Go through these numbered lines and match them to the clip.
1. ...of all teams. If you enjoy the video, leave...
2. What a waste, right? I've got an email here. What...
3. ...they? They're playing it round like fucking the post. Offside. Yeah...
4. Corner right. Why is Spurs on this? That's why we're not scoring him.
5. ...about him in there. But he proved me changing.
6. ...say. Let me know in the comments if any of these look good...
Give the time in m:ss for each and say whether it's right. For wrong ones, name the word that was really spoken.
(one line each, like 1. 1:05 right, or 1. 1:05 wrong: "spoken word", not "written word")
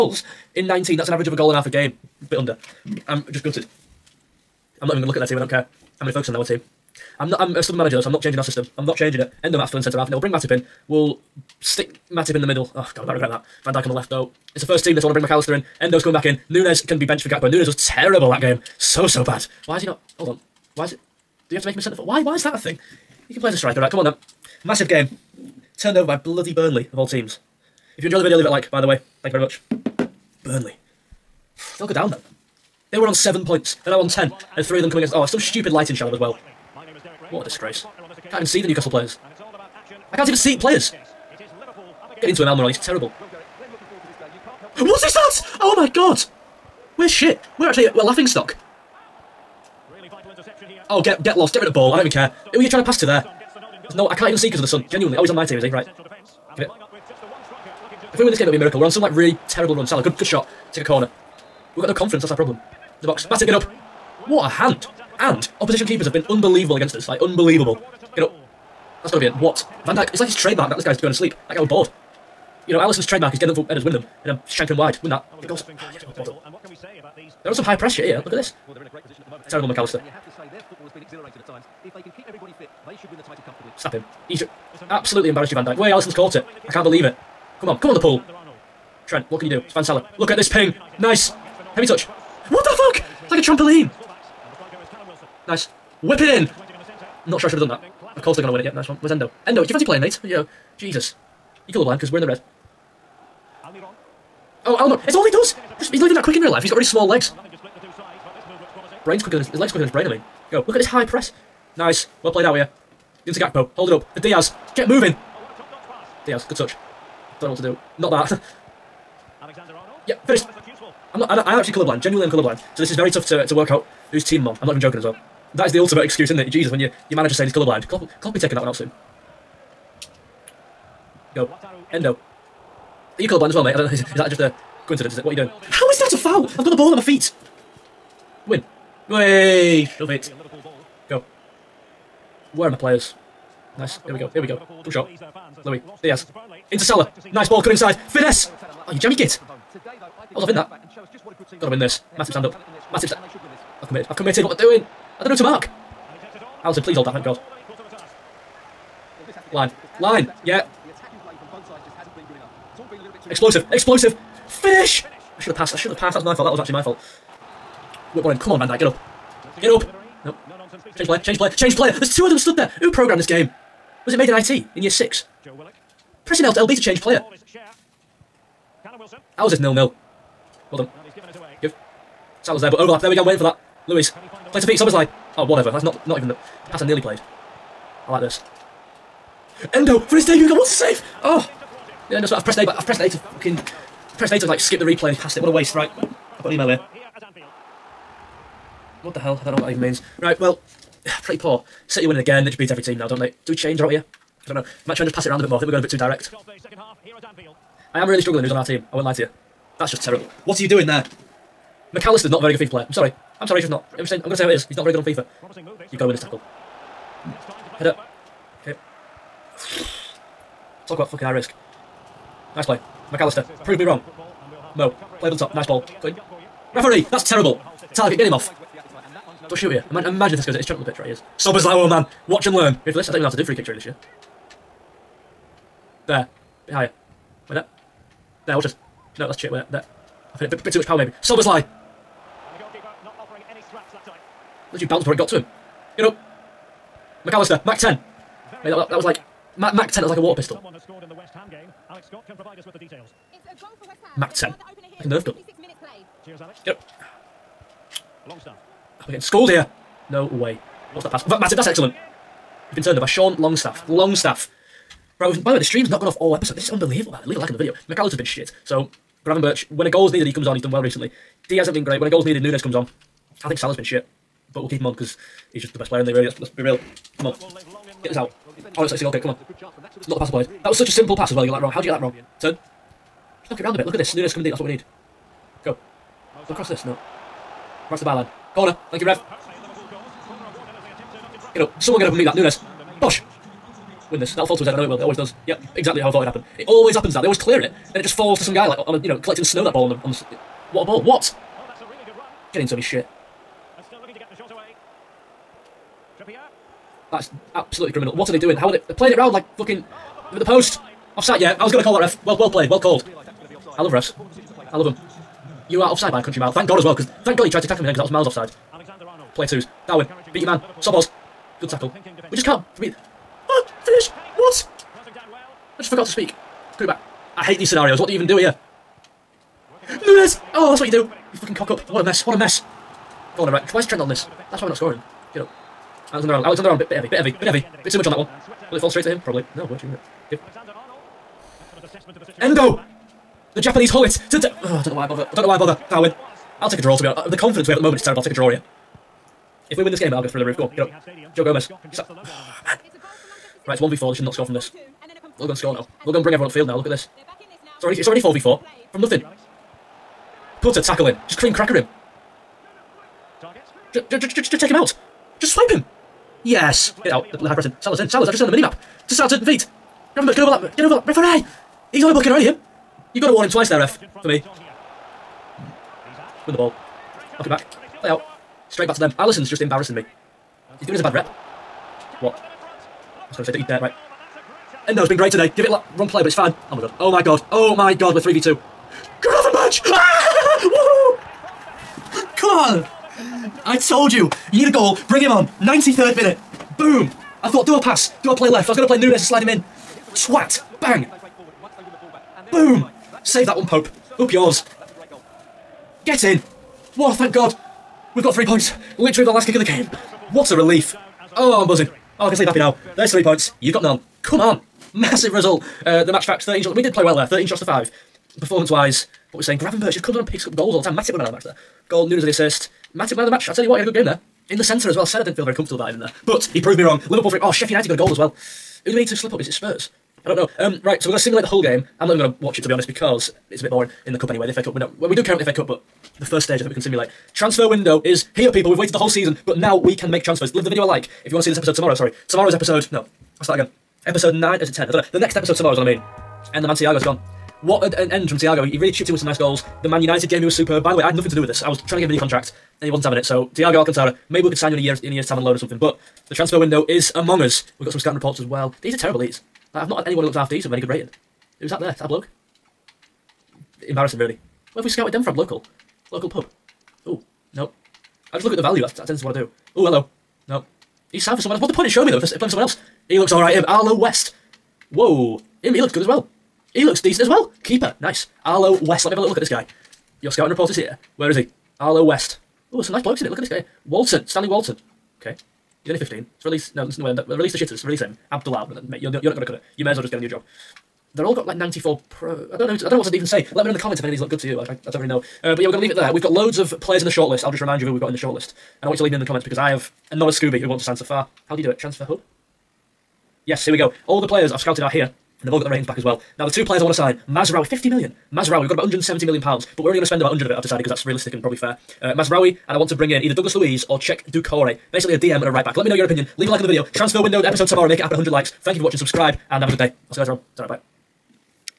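1. 0:26 right
2. 3:15 right
3. 5:08 right
4. 5:33 wrong: "Trent", not "Spurs"
5. 7:05 wrong: "wrong", not "changing"
6. 8:13 right.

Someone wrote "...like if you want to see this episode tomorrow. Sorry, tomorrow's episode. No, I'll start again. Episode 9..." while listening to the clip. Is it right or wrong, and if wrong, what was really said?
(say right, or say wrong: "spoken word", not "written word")
right.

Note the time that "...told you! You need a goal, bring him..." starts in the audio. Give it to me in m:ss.
6:33.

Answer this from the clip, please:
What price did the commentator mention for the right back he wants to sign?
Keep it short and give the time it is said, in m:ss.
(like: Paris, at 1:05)
50 million, at 8:27.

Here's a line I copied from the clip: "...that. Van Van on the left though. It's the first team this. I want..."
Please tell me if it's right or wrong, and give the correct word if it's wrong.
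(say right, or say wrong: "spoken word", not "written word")
wrong: "Dijk", not "Van".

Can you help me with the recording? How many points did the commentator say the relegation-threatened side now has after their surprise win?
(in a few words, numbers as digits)
10.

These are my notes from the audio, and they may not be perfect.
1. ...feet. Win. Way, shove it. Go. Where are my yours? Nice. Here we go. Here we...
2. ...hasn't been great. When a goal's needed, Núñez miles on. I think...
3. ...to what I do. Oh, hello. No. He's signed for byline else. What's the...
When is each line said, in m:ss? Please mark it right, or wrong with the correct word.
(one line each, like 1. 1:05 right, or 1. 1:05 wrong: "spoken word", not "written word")
1. 2:17 wrong: "players", not "yours"
2. 4:31 wrong: "comes", not "miles"
3. 7:49 wrong: "someone", not "byline".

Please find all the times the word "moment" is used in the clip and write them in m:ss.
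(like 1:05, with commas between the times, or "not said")
1:19, 5:47.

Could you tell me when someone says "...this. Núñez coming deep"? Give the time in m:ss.
4:43.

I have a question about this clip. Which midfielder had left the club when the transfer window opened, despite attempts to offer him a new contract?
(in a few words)
Thiago Alcantara.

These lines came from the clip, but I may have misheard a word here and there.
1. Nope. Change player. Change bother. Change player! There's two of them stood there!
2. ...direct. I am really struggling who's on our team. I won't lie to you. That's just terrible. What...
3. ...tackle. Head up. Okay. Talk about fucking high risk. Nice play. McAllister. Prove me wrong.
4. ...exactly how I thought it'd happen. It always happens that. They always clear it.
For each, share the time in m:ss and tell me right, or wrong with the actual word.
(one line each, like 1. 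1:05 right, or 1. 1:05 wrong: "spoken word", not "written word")
1. 2:50 wrong: "player", not "bother"
2. 3:25 right
3. 3:36 right
4. 4:55 right.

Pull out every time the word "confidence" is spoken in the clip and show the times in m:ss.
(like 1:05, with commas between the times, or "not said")
1:01, 5:47.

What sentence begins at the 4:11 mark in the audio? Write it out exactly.
Alex Scott can provide us with the details.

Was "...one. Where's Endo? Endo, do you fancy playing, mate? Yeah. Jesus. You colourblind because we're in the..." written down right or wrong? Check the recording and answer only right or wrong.
right.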